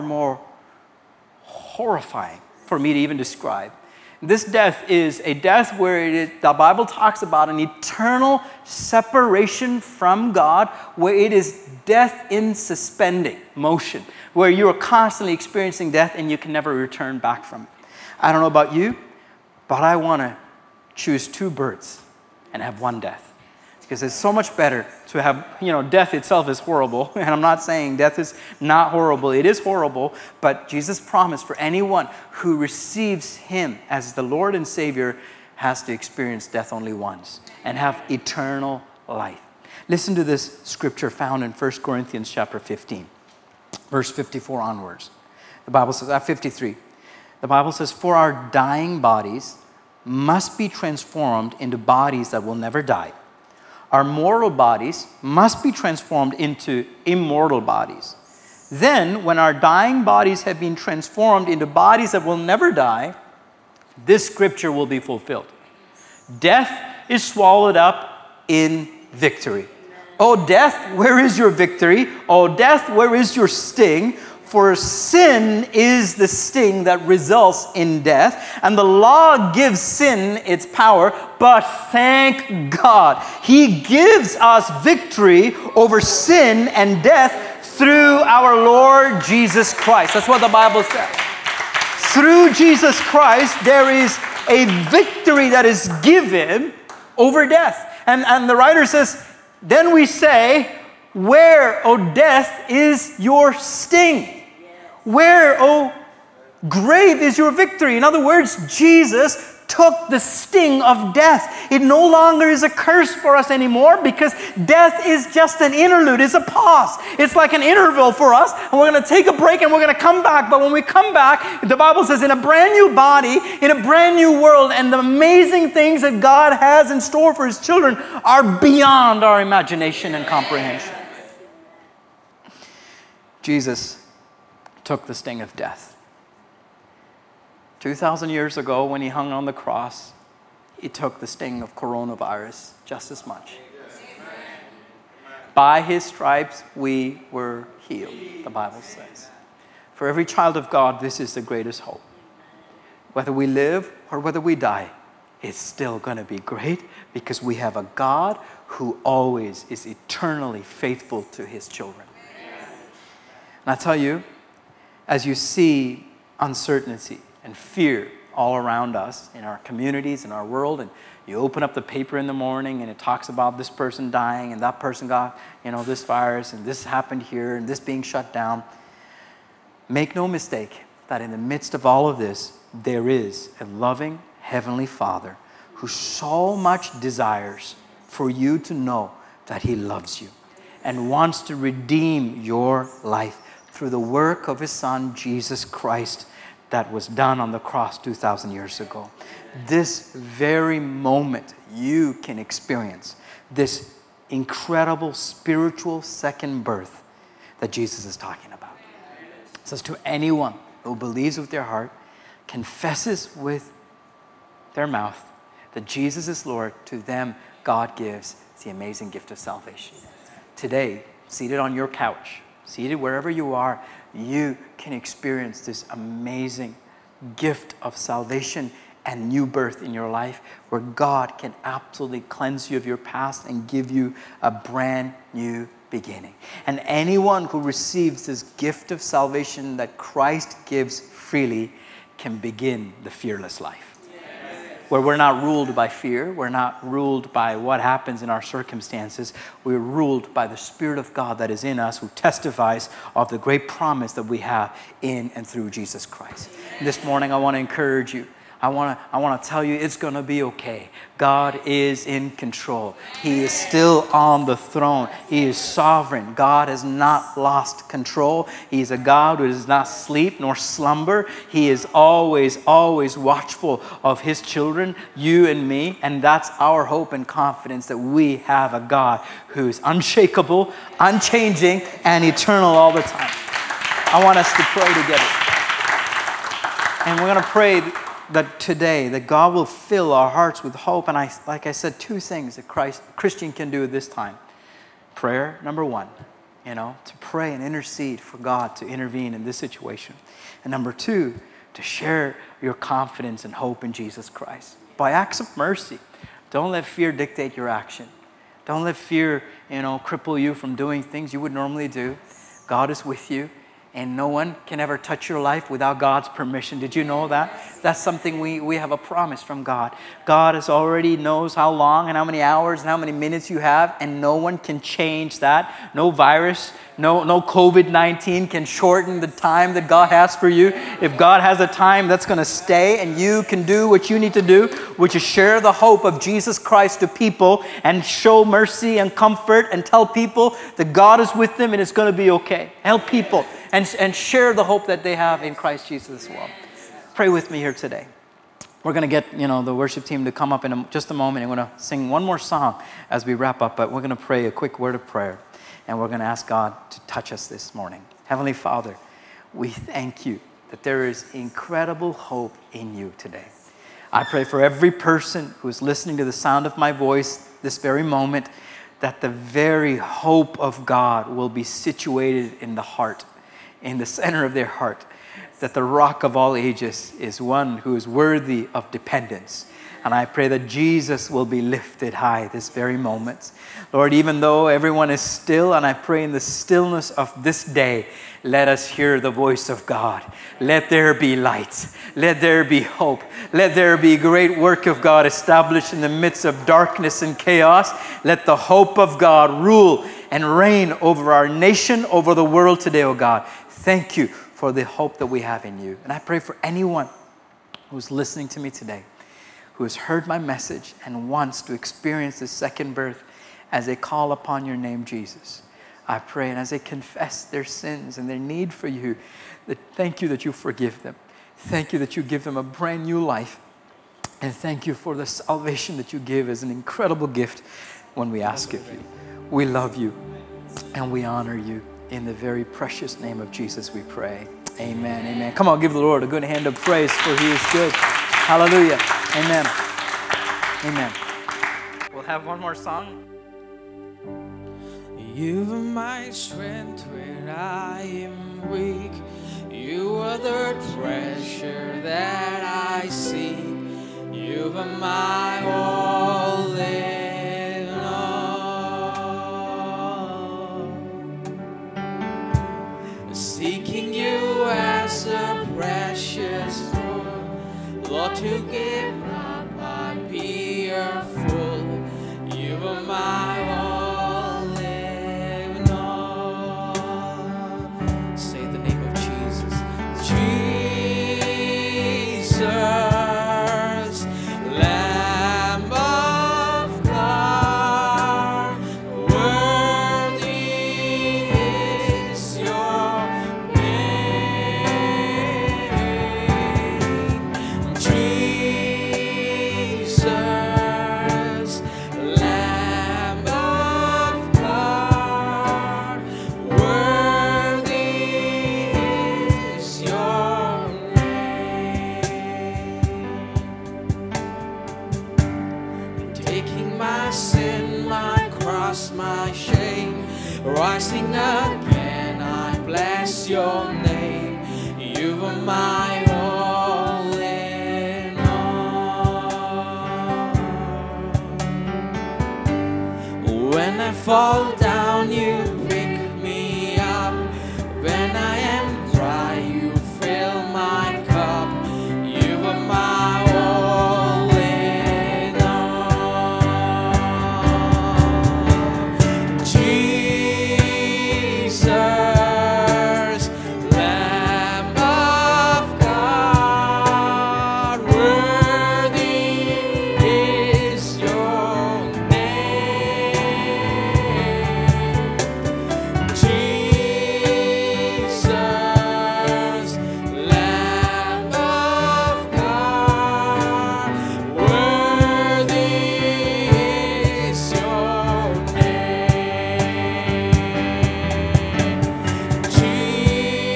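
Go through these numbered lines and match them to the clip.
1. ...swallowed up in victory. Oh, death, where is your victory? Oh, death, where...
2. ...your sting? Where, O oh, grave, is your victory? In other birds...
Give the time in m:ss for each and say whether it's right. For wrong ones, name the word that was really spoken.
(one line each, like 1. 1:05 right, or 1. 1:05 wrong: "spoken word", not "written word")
1. 1:07 right
2. 1:43 wrong: "words", not "birds".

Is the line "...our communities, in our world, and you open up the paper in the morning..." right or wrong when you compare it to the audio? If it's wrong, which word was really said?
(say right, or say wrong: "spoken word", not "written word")
right.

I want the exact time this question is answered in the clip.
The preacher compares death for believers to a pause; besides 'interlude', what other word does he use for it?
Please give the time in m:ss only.
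1:57.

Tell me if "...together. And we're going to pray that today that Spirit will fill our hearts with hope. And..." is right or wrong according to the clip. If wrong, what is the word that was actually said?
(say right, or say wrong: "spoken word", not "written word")
wrong: "God", not "Spirit".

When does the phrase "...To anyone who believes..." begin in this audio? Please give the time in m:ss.
3:29.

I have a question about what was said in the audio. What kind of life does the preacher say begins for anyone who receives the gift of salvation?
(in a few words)
the fearless life.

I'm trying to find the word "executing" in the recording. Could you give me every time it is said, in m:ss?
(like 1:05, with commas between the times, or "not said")
not said.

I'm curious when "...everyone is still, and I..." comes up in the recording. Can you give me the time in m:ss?
6:24.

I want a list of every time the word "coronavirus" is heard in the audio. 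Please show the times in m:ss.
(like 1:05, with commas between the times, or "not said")
2:21.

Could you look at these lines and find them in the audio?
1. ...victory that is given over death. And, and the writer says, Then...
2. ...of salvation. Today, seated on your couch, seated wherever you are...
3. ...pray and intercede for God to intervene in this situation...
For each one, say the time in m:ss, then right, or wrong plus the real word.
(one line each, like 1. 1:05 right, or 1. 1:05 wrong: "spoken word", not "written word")
1. 1:34 right
2. 3:39 right
3. 4:57 right.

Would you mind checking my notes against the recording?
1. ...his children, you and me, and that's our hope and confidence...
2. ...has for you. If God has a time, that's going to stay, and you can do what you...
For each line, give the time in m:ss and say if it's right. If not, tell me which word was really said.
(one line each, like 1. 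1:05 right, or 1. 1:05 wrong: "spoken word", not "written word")
1. 4:34 right
2. 5:30 right.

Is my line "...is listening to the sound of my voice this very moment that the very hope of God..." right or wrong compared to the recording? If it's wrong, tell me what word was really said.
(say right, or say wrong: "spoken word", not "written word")
right.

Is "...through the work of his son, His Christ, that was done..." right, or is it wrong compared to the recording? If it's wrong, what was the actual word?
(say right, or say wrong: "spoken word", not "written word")
wrong: "Jesus", not "His".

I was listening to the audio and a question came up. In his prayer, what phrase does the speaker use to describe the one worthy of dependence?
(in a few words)
the rock of all ages.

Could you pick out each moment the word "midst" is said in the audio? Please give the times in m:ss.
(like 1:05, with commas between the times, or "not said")
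3:01, 6:36.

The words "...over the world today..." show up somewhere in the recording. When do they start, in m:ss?
6:42.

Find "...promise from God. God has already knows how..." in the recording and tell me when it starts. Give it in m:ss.
5:18.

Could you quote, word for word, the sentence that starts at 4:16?
And this morning, I want to encourage you I want to I want to tell you it's going to be okay.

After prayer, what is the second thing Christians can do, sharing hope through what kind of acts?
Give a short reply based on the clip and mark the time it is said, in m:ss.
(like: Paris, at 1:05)
acts of mercy, at 5:05.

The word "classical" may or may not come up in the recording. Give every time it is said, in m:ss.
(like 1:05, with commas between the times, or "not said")
not said.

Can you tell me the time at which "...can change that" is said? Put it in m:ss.
5:24.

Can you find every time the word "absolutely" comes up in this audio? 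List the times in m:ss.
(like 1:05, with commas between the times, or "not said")
3:51.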